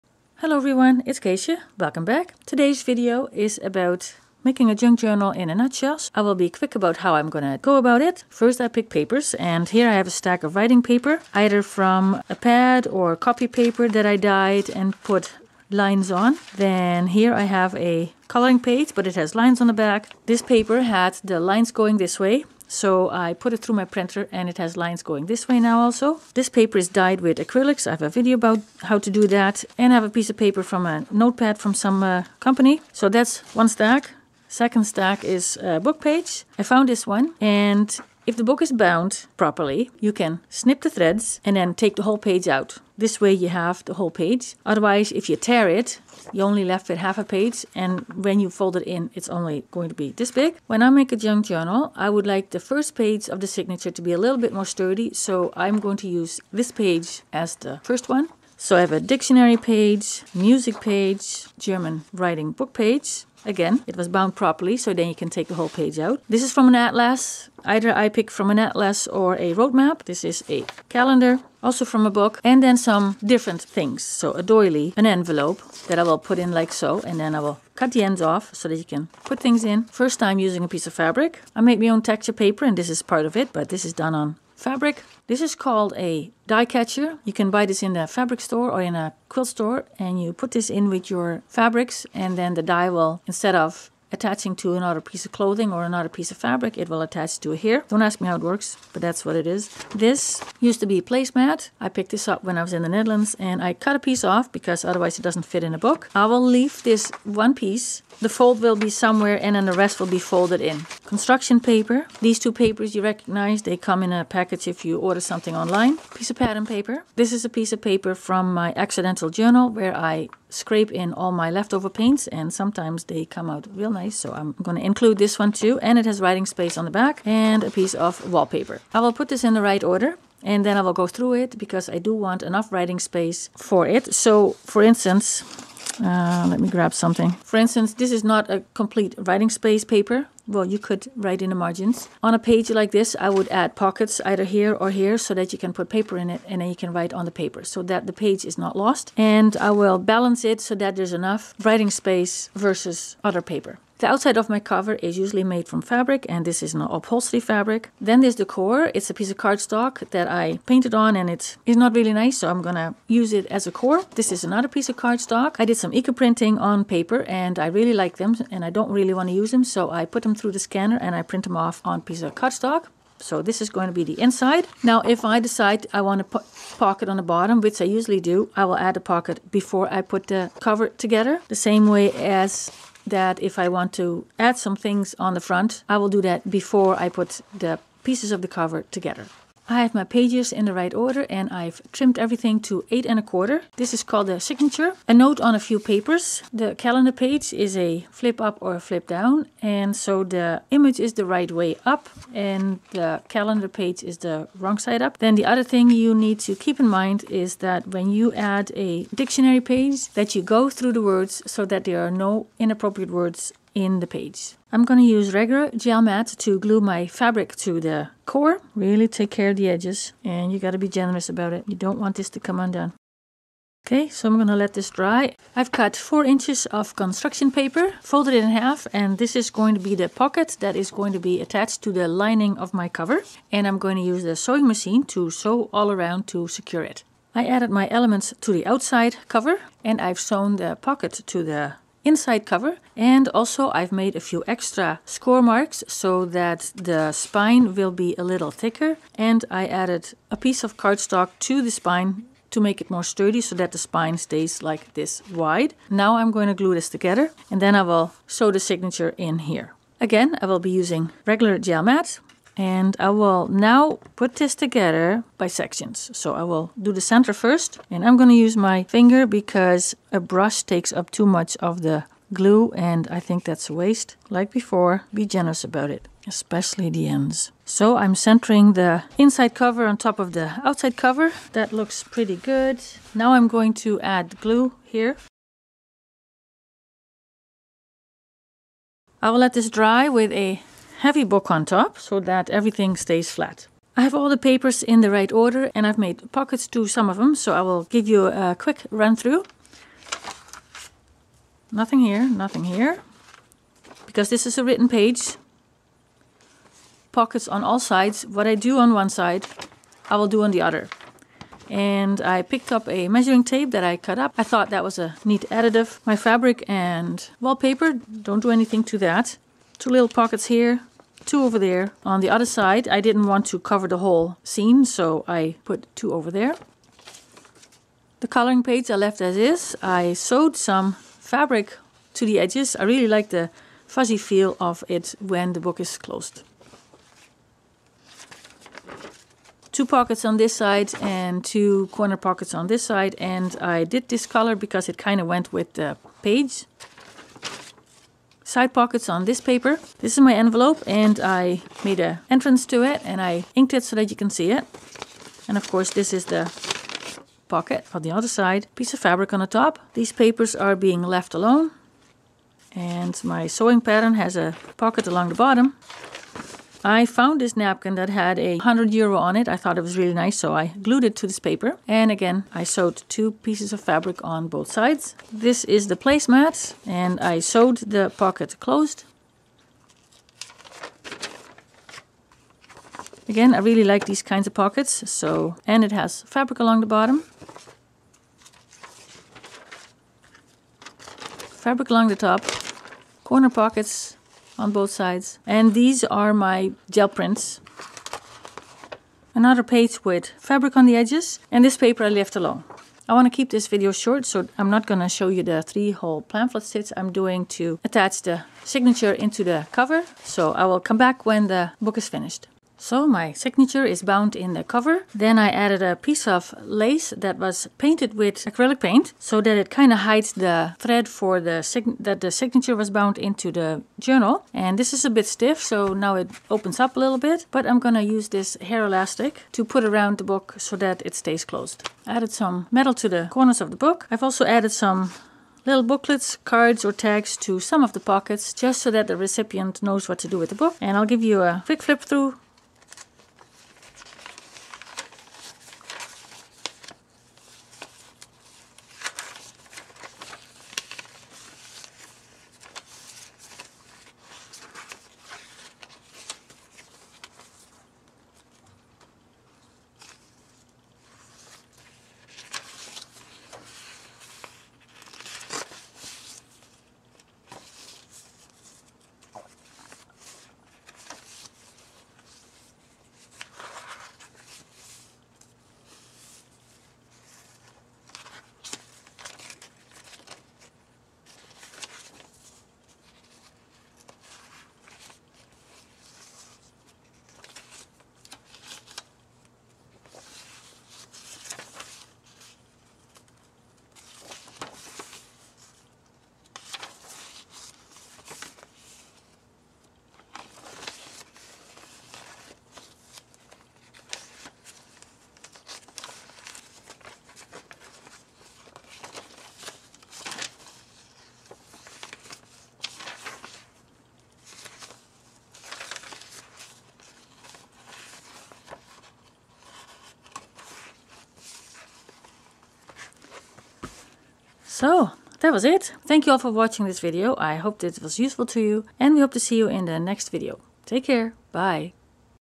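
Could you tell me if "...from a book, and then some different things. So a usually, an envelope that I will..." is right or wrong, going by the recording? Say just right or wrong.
wrong.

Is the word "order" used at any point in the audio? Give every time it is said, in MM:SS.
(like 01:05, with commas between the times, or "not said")
01:54, 02:09, 03:10, 04:55.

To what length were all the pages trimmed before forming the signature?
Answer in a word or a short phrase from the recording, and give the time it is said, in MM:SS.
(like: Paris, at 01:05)
8 1/4, at 03:12.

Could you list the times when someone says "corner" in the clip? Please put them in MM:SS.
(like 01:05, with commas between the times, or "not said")
05:41, 06:33, 07:13.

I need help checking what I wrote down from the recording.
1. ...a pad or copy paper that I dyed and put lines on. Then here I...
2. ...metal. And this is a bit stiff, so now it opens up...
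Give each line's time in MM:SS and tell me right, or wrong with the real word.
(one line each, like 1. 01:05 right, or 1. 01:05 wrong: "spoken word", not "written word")
1. 00:12 right
2. 07:03 wrong: "journal", not "metal".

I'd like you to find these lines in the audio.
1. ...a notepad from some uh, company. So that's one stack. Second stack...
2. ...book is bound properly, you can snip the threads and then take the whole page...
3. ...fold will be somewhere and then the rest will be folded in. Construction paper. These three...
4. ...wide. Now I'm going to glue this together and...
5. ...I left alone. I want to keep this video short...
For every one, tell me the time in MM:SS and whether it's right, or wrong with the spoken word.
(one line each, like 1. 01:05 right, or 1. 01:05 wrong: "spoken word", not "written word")
1. 00:30 right
2. 00:38 right
3. 01:48 wrong: "two", not "three"
4. 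04:15 right
5. 06:42 right.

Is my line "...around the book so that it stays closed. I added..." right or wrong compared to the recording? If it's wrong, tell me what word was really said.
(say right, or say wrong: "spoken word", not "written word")
right.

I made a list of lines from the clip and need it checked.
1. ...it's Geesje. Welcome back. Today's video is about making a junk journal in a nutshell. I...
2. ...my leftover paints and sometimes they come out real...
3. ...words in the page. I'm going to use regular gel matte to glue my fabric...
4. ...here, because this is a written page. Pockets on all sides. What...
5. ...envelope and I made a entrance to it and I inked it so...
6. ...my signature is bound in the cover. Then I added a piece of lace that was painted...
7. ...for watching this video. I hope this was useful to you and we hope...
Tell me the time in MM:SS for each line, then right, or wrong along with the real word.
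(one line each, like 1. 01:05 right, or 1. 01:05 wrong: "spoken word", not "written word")
1. 00:01 right
2. 02:01 right
3. 03:33 right
4. 05:02 right
5. 05:50 right
6. 06:53 right
7. 08:46 right.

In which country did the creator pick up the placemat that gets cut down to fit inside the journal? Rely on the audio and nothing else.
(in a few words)
Netherlands.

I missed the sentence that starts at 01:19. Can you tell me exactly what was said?
First time using a piece of fabric.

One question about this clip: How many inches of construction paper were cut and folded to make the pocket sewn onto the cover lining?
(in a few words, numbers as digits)
4.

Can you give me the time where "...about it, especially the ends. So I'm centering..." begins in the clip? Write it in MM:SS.
04:35.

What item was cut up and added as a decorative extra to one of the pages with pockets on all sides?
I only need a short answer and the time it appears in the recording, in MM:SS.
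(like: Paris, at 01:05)
measuring tape, at 05:13.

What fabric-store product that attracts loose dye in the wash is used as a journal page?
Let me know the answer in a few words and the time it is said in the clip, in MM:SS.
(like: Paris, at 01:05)
dye catcher, at 01:26.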